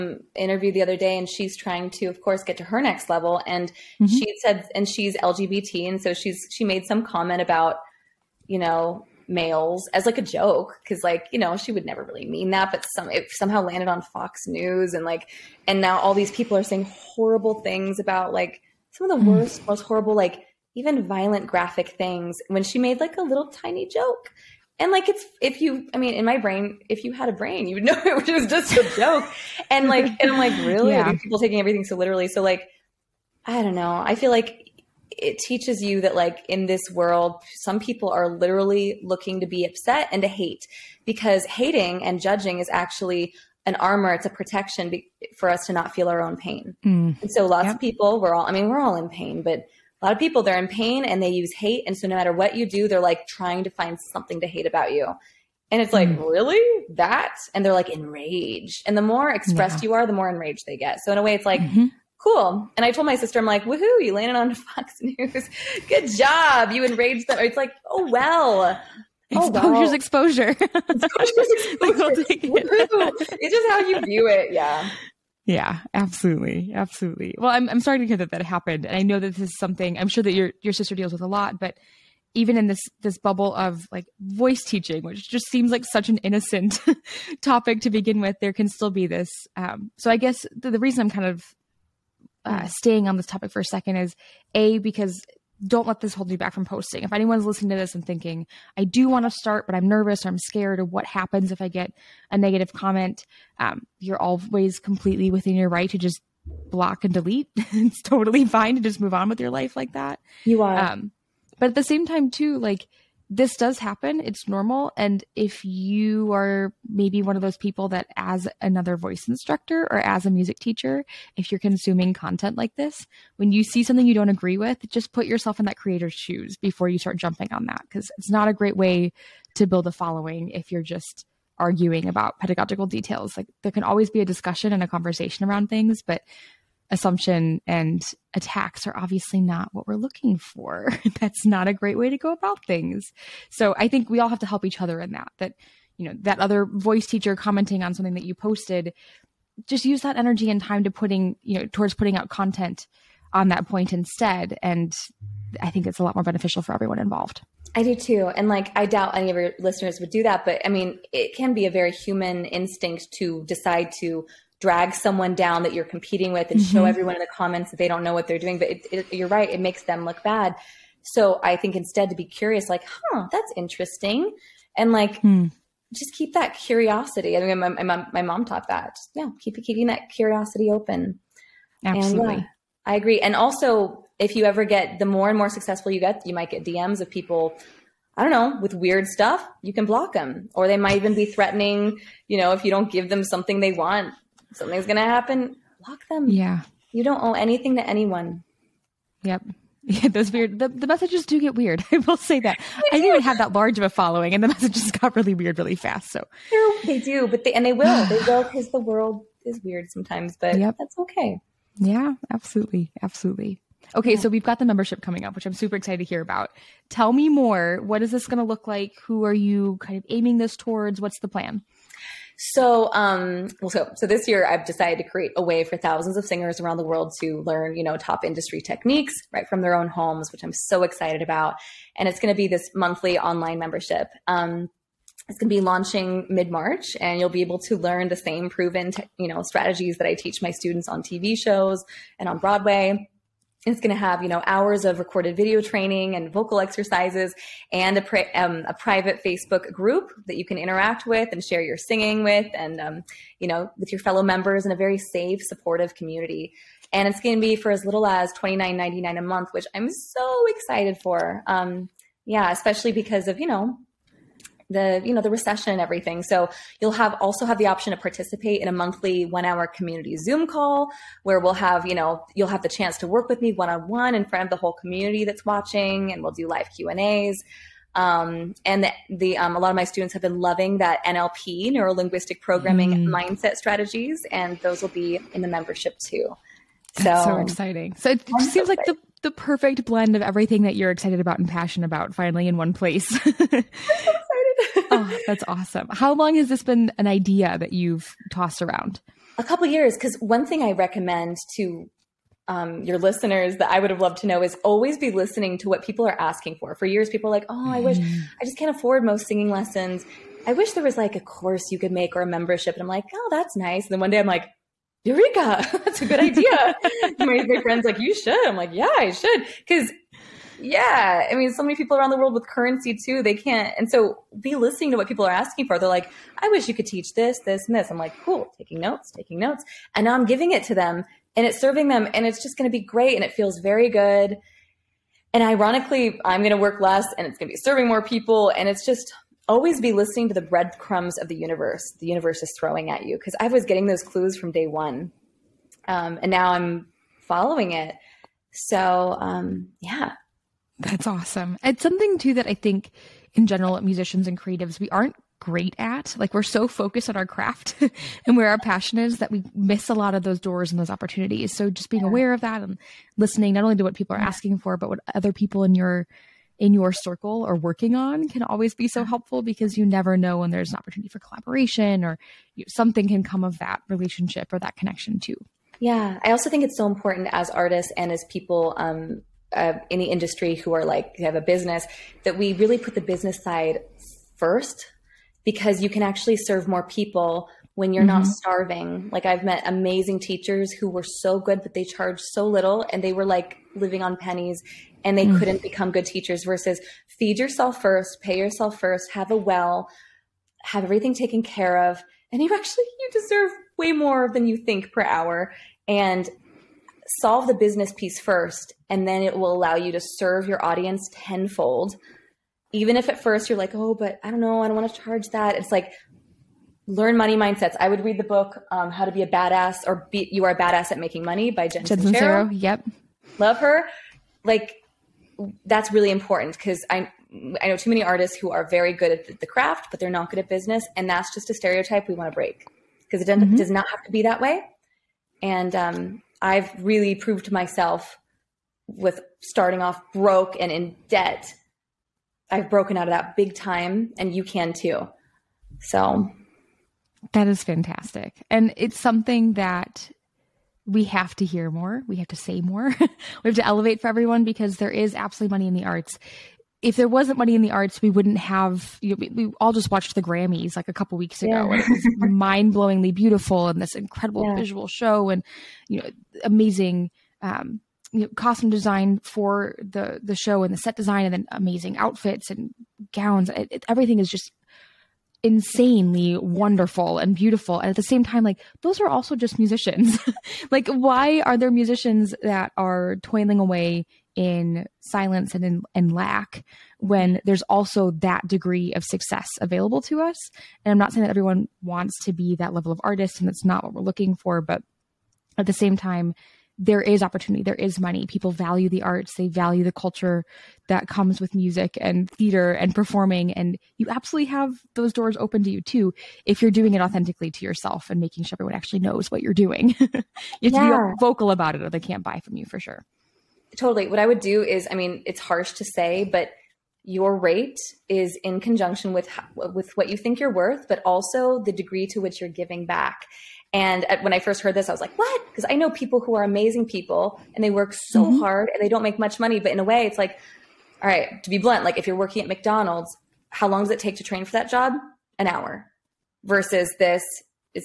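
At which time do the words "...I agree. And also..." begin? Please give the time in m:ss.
3:02.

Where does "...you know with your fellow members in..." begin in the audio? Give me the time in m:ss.
4:13.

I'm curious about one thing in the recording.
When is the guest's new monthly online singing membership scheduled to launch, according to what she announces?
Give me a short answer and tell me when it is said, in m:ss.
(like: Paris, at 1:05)
Mid-March, at 3:56.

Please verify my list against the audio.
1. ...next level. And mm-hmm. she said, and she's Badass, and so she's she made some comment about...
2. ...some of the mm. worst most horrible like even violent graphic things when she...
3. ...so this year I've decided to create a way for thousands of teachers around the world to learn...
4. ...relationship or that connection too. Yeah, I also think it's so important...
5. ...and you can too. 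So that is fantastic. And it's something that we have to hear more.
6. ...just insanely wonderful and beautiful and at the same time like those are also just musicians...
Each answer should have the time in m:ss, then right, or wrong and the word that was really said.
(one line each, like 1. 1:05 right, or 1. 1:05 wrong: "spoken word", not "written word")
1. 0:02 wrong: "LGBT", not "Badass"
2. 0:18 right
3. 3:43 wrong: "singers", not "teachers"
4. 6:13 right
5. 7:24 right
6. 7:54 right.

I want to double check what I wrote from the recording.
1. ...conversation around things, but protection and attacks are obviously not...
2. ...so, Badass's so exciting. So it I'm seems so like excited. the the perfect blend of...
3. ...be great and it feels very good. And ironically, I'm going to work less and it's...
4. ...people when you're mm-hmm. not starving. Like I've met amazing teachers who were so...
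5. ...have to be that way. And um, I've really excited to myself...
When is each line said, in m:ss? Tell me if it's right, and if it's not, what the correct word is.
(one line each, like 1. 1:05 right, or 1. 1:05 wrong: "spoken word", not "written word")
1. 2:14 wrong: "assumption", not "protection"
2. 4:46 wrong: "That", not "Badass"
3. 5:32 right
4. 6:26 right
5. 7:13 wrong: "proved", not "excited".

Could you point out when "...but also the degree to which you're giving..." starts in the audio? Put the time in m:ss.
8:40.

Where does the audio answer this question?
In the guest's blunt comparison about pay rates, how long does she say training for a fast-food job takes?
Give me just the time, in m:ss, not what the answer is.
8:55.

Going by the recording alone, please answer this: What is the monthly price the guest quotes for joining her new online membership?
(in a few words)
$29.99.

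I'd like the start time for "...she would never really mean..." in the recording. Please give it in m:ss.
0:11.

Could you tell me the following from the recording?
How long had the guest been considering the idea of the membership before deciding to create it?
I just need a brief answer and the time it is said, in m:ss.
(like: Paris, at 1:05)
A couple years, at 4:59.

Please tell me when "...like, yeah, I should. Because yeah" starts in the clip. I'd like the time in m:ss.
5:18.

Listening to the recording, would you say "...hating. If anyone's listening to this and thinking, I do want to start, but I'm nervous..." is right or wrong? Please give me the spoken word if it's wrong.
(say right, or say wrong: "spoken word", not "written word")
wrong: "posting", not "hating".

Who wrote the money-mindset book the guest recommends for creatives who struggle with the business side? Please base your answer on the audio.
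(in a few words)
Jen Sincero.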